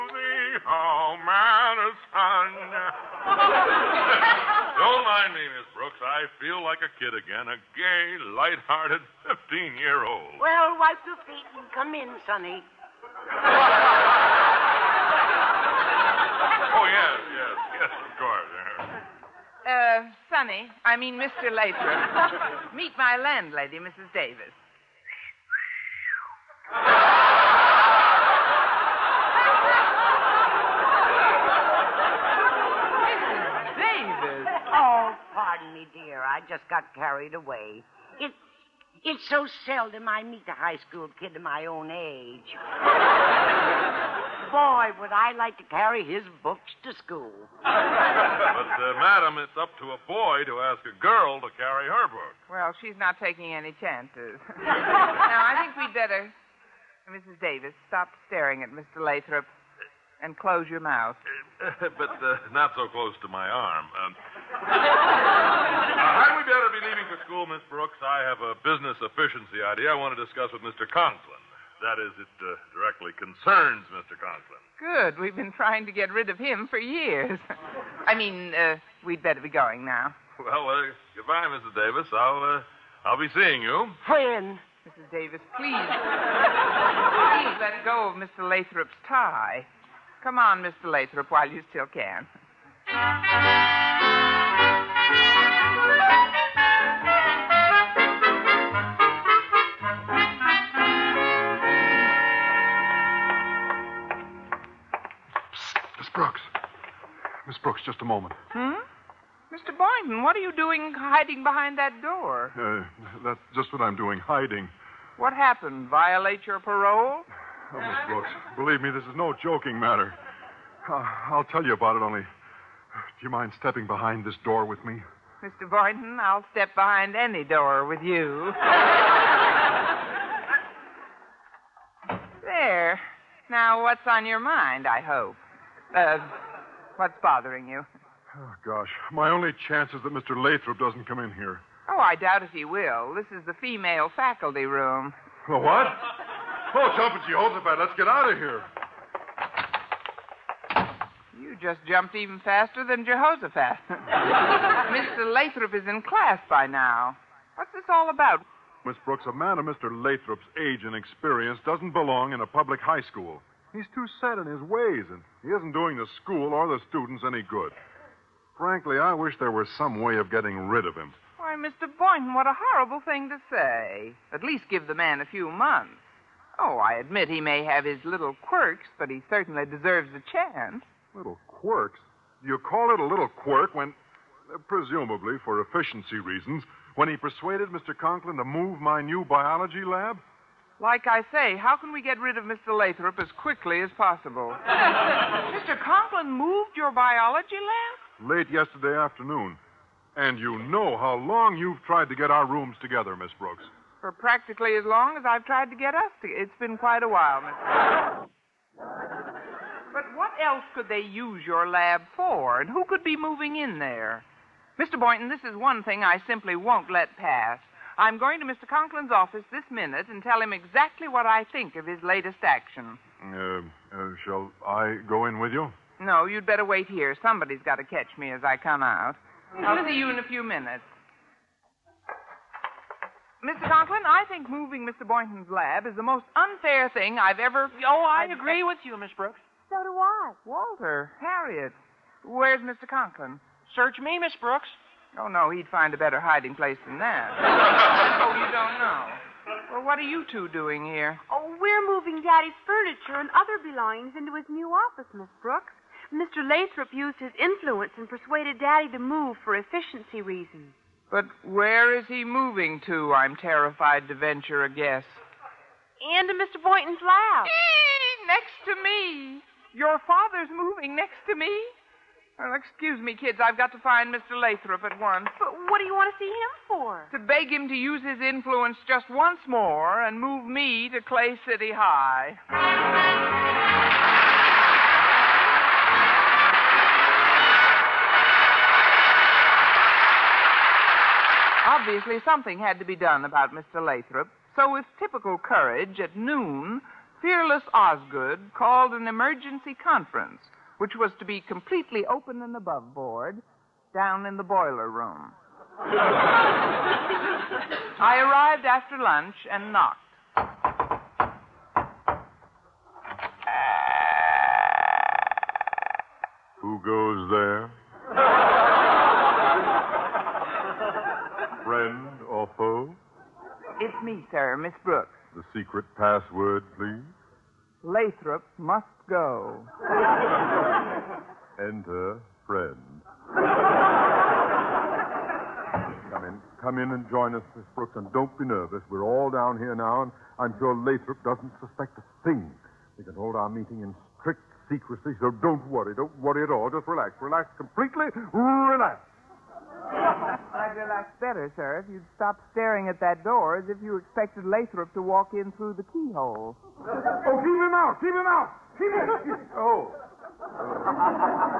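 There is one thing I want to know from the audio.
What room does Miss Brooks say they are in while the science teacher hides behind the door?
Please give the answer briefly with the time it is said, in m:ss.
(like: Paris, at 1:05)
female faculty room, at 2:23.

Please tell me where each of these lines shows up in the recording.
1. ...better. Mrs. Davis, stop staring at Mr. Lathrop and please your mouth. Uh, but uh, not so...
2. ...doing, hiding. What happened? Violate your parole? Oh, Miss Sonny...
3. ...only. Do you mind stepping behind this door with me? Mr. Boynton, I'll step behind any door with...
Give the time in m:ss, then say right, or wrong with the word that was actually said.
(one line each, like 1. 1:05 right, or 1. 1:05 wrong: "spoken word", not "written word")
1. 0:55 wrong: "close", not "please"
2. 1:53 wrong: "Brooks", not "Sonny"
3. 2:02 right.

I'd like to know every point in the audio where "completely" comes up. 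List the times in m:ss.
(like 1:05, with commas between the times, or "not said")
5:01, 5:47.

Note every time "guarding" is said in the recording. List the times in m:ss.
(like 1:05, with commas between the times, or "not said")
not said.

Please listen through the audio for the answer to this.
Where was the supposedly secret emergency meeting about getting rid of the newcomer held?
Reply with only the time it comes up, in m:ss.
5:04.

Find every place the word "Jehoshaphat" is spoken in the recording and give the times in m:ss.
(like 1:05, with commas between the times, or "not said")
2:27, 2:33.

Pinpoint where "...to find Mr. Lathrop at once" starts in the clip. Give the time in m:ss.
4:33.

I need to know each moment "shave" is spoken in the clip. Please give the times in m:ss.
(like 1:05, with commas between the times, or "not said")
not said.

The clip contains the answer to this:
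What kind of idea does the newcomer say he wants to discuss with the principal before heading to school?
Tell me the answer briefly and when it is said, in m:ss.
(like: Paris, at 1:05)
business efficiency idea, at 1:08.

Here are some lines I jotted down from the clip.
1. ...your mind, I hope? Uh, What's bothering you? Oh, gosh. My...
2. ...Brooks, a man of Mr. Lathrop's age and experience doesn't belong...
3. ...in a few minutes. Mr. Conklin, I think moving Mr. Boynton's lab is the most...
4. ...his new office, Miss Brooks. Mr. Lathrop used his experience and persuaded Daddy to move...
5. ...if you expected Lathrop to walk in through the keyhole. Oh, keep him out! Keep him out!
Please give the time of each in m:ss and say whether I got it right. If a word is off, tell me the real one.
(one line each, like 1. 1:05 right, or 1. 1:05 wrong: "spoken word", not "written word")
1. 2:14 right
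2. 2:39 right
3. 3:50 right
4. 4:14 wrong: "influence", not "experience"
5. 5:53 right.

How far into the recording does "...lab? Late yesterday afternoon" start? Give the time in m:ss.
3:17.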